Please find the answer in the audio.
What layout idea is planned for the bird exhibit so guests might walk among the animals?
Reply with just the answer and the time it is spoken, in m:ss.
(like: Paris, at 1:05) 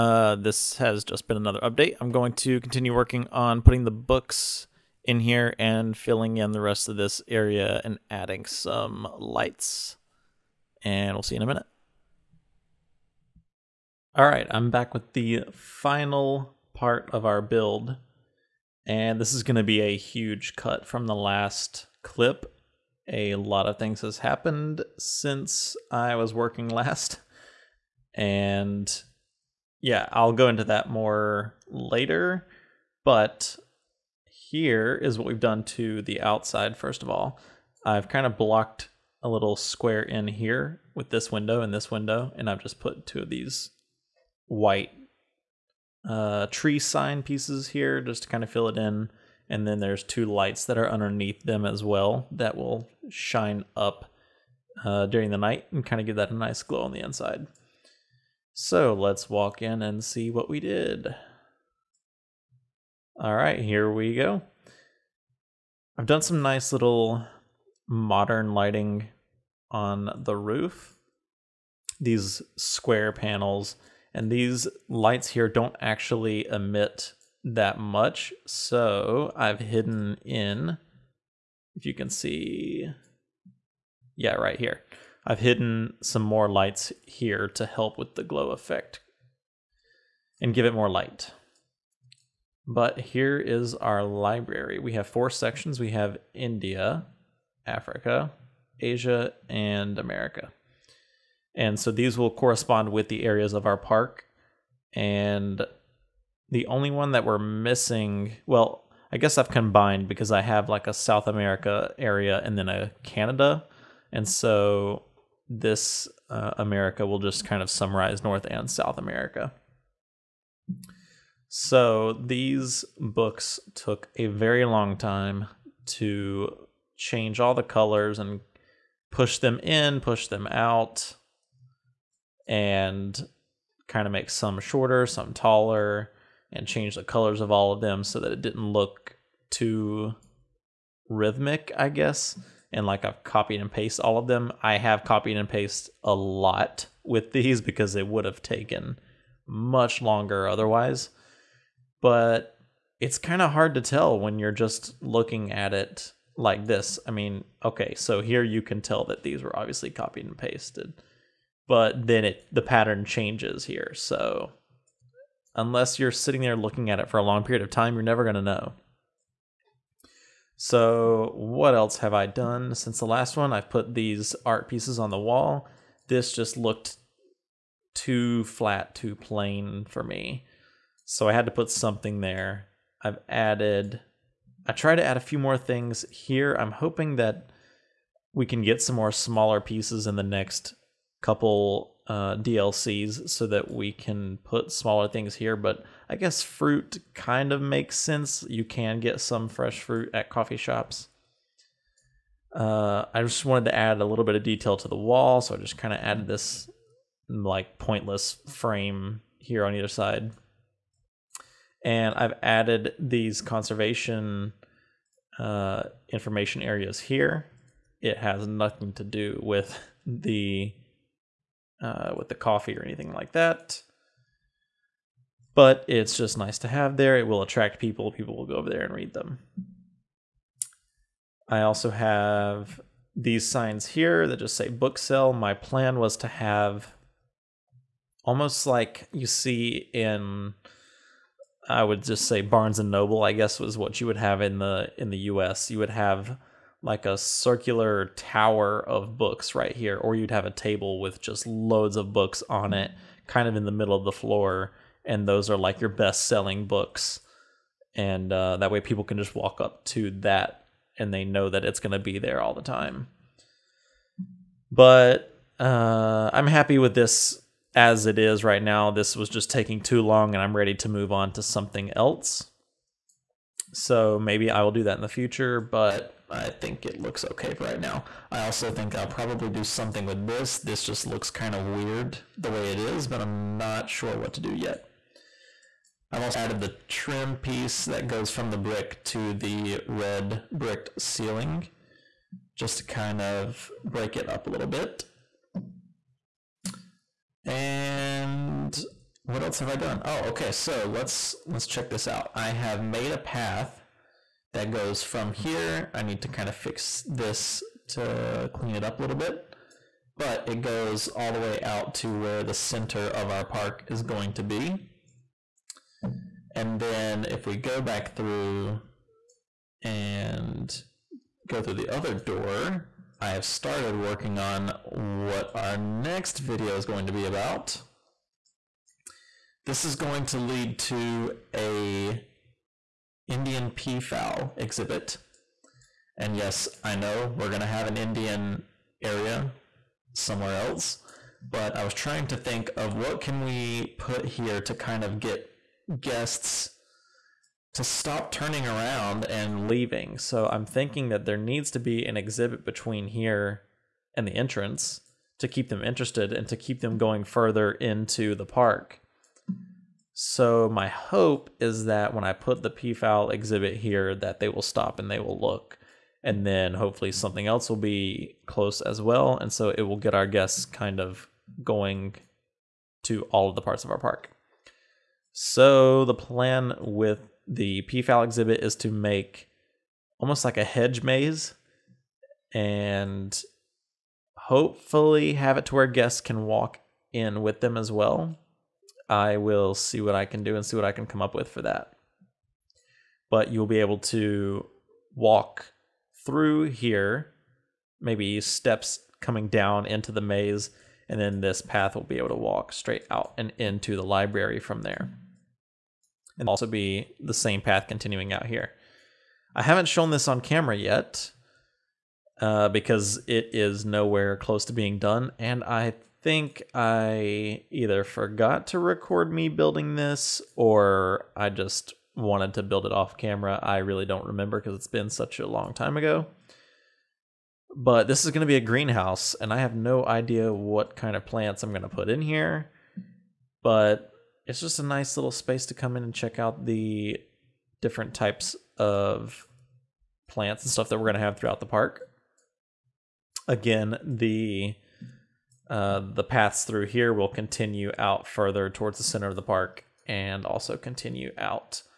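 Hedge maze, at 6:20.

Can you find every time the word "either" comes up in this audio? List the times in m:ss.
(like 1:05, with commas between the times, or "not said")
3:29, 6:57.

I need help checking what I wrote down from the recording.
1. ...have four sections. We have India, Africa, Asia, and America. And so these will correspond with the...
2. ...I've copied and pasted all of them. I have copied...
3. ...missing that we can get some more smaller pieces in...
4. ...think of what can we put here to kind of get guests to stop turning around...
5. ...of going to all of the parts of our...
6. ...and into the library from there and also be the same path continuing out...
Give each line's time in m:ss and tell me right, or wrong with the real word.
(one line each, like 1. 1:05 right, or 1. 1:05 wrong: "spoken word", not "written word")
1. 1:34 right
2. 2:23 right
3. 3:06 wrong: "hoping", not "missing"
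4. 5:42 right
5. 6:10 right
6. 6:43 right.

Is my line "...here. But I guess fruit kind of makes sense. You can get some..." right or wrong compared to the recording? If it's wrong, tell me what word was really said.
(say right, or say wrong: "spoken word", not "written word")
right.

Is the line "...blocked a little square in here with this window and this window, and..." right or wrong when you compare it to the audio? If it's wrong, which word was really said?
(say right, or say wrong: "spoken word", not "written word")
right.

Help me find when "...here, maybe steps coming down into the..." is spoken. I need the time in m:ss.
6:36.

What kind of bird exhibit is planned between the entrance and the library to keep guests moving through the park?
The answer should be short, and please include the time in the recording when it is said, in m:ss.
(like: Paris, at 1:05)
Indian peafowl, at 5:33.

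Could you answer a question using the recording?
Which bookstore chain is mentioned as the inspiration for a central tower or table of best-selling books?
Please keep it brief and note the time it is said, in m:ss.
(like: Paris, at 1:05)
Barnes and Noble, at 4:02.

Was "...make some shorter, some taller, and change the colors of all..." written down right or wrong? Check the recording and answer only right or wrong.
right.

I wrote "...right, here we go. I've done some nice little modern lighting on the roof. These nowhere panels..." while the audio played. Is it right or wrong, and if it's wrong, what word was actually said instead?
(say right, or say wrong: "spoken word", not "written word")
wrong: "square", not "nowhere".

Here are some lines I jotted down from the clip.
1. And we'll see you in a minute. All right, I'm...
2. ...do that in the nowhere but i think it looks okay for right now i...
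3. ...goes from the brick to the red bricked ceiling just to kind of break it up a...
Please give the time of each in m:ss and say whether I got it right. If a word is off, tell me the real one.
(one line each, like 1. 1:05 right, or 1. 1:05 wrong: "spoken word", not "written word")
1. 0:10 right
2. 4:34 wrong: "future", not "nowhere"
3. 4:48 right.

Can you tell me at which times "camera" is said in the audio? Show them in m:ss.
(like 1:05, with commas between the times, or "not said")
6:50, 7:03.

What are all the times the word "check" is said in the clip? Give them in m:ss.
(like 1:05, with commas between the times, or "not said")
5:01, 7:16.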